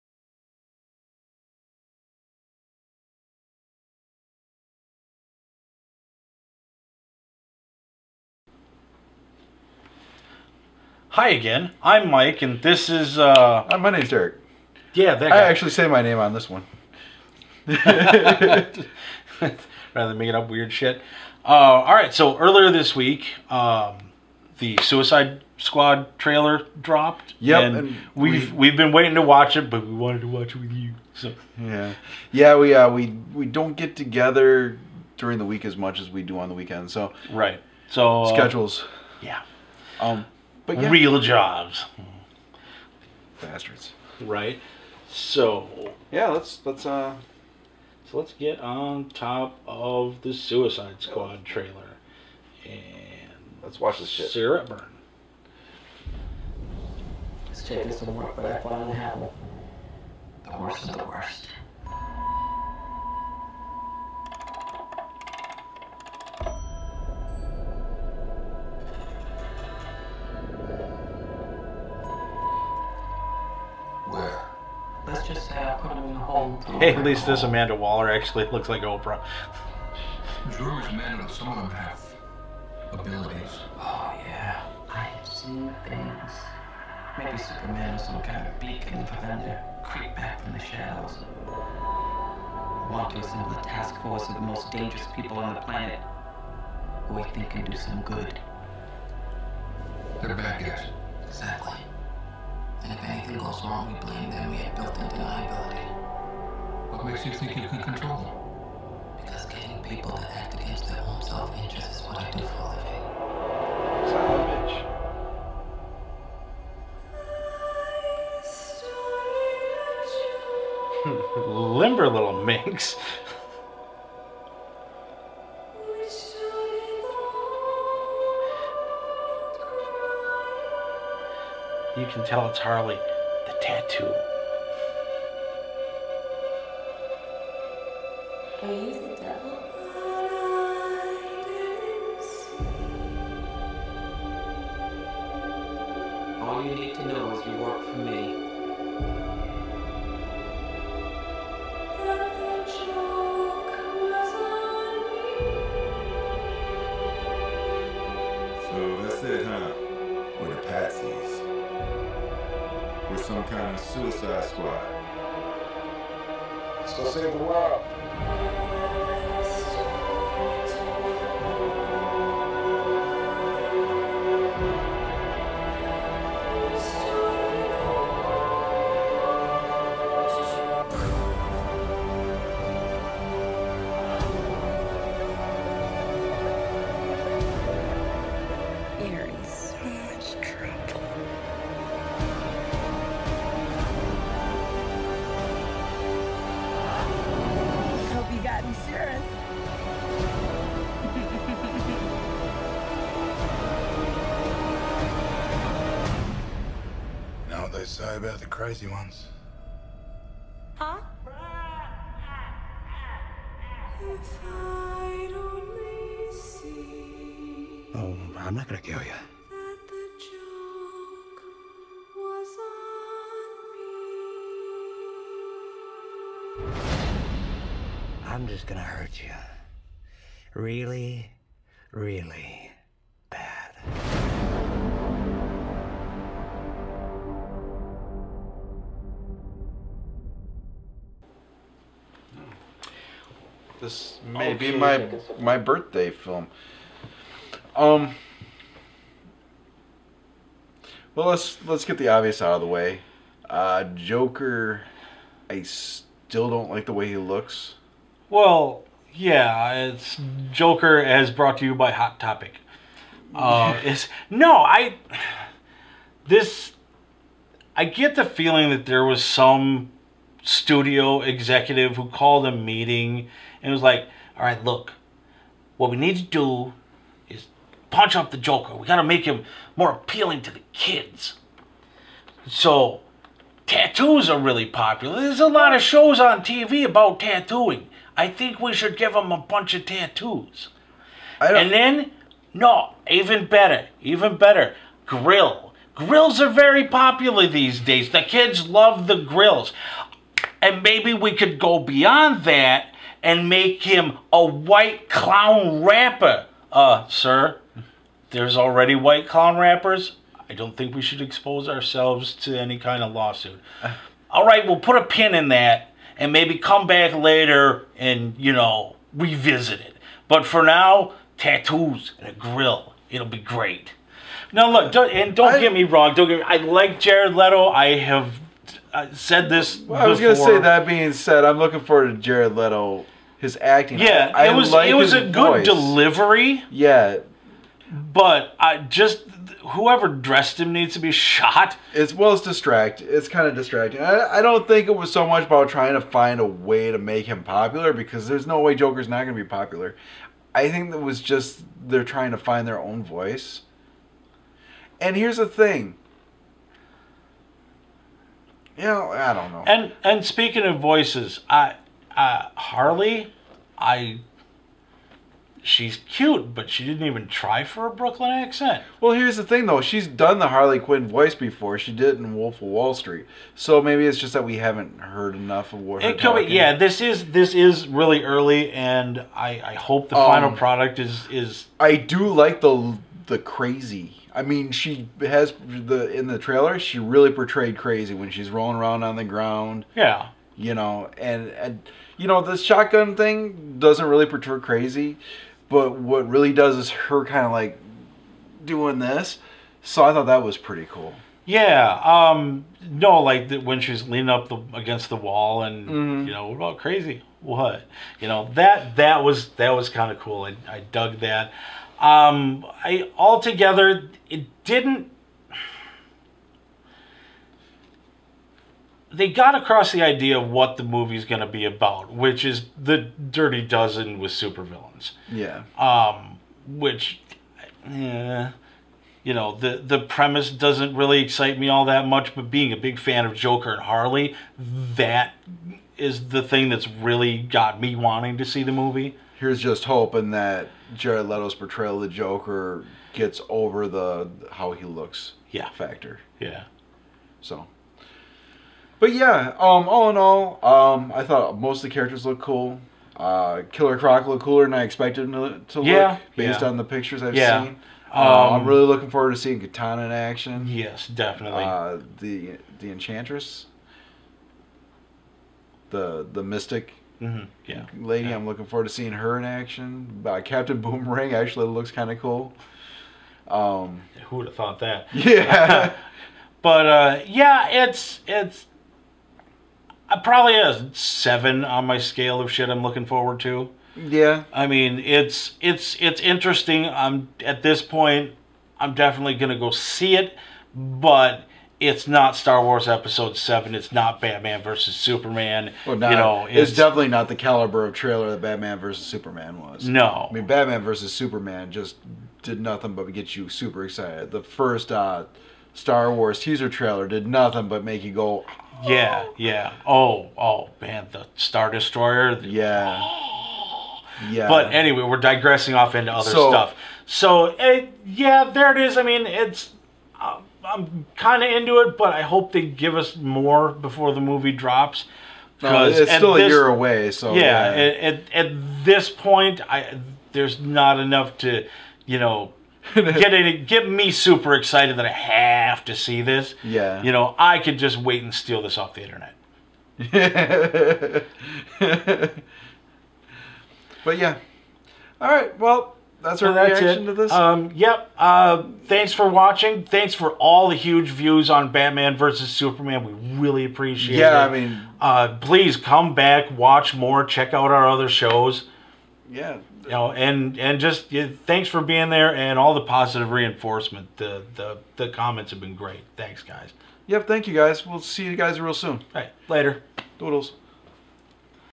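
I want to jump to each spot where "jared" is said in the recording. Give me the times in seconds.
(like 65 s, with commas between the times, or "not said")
326 s, 332 s, 440 s.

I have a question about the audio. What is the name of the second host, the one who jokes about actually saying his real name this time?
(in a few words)
Derek.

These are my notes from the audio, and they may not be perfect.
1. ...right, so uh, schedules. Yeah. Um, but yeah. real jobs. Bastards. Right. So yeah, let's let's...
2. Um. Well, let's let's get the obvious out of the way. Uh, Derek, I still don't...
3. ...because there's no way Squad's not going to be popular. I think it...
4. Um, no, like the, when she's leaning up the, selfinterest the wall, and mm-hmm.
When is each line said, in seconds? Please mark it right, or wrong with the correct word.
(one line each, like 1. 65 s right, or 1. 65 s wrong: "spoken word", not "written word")
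1. 37 s right
2. 247 s wrong: "Joker", not "Derek"
3. 347 s wrong: "Joker", not "Squad"
4. 402 s wrong: "against", not "selfinterest".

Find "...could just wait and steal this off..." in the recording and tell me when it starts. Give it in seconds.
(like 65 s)
537 s.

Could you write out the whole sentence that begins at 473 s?
Um, Who would have thought that?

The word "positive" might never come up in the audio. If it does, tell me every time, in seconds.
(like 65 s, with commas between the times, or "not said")
562 s.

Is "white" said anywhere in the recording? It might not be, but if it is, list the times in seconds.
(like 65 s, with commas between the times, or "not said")
304 s, 308 s.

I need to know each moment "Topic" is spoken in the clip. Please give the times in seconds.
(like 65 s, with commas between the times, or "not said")
262 s.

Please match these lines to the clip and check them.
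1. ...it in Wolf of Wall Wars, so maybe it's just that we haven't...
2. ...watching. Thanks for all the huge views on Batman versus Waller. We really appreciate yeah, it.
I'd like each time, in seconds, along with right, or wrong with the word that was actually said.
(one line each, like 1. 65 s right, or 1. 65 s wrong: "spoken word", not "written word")
1. 372 s wrong: "Street", not "Wars"
2. 549 s wrong: "Superman", not "Waller".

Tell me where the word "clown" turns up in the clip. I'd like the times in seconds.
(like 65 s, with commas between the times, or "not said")
305 s, 309 s.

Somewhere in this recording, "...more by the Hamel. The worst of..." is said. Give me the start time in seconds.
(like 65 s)
58 s.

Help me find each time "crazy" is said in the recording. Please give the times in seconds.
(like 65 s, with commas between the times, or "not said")
208 s, 383 s, 387 s, 394 s, 406 s.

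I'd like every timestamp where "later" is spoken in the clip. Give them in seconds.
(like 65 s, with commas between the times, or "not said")
317 s, 569 s.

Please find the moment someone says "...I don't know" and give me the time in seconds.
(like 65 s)
359 s.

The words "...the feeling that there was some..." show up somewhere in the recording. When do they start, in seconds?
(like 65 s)
268 s.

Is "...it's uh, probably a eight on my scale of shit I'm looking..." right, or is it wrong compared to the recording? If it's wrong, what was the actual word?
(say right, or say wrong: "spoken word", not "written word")
wrong: "seven", not "eight".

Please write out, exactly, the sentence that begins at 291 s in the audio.
And then, no, even better, even better, grill.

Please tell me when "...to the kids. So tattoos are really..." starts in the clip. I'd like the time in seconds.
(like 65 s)
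280 s.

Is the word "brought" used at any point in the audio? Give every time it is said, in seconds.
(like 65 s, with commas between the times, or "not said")
261 s.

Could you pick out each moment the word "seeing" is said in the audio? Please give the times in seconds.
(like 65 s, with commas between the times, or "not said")
459 s, 468 s.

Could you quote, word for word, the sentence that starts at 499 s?
No, I mean Batman versus Superman just did nothing but get you super excited.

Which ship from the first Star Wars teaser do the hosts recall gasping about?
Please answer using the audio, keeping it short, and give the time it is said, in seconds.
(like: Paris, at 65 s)
Star Destroyer, at 511 s.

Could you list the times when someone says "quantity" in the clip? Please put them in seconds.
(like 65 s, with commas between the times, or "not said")
not said.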